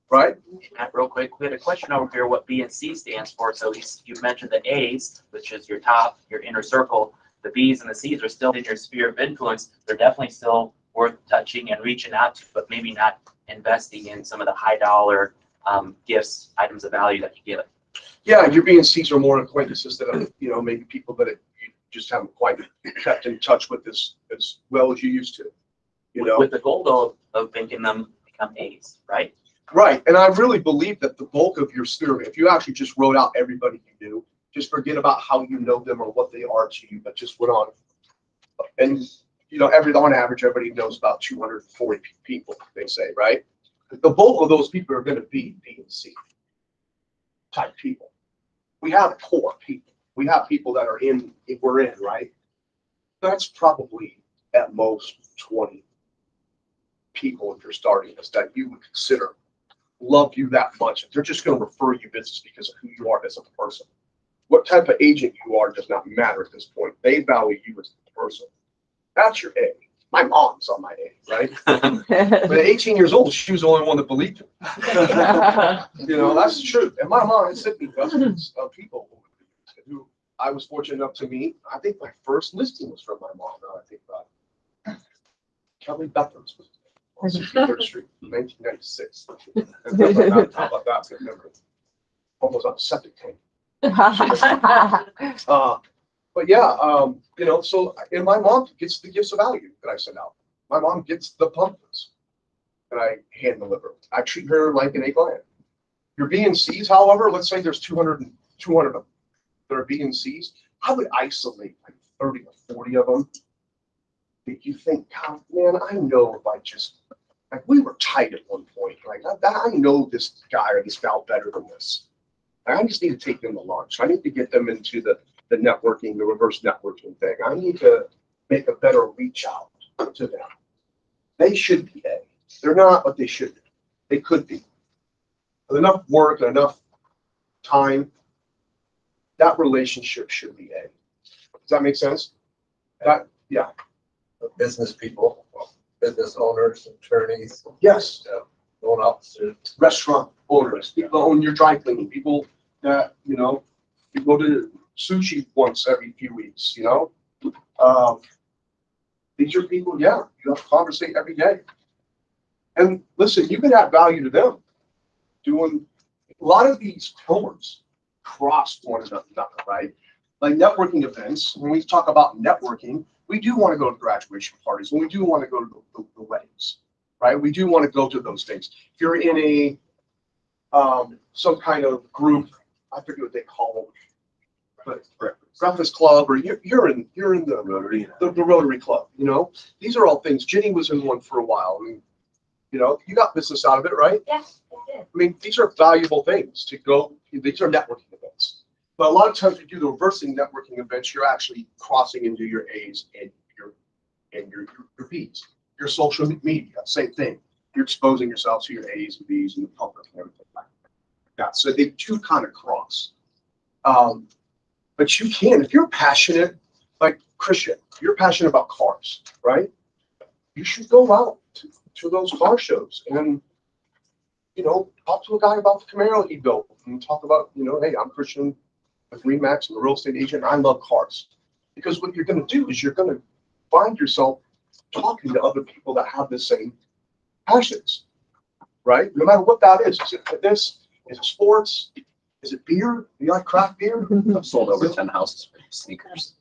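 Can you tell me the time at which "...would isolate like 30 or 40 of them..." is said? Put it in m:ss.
1:50.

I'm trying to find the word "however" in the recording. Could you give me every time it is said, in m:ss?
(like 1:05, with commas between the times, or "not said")
1:46.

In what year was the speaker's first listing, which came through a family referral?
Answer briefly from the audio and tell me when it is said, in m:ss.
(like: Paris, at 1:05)
1996, at 1:28.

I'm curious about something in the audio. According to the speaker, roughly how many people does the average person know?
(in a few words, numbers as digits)
240.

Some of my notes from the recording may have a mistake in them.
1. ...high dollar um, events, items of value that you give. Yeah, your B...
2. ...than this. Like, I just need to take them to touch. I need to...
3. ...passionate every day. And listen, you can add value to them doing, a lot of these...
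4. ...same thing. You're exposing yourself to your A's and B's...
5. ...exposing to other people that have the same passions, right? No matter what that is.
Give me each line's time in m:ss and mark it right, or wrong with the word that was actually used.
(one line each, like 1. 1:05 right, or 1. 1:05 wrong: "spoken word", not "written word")
1. 0:14 wrong: "gifts", not "events"
2. 2:01 wrong: "lunch", not "touch"
3. 2:40 wrong: "conversate", not "passionate"
4. 3:26 right
5. 3:54 wrong: "talking", not "exposing".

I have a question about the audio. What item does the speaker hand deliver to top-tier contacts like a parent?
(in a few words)
Pumpkins.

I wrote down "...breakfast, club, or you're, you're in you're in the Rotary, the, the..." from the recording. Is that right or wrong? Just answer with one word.
right.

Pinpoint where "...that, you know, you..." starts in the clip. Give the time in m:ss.
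2:32.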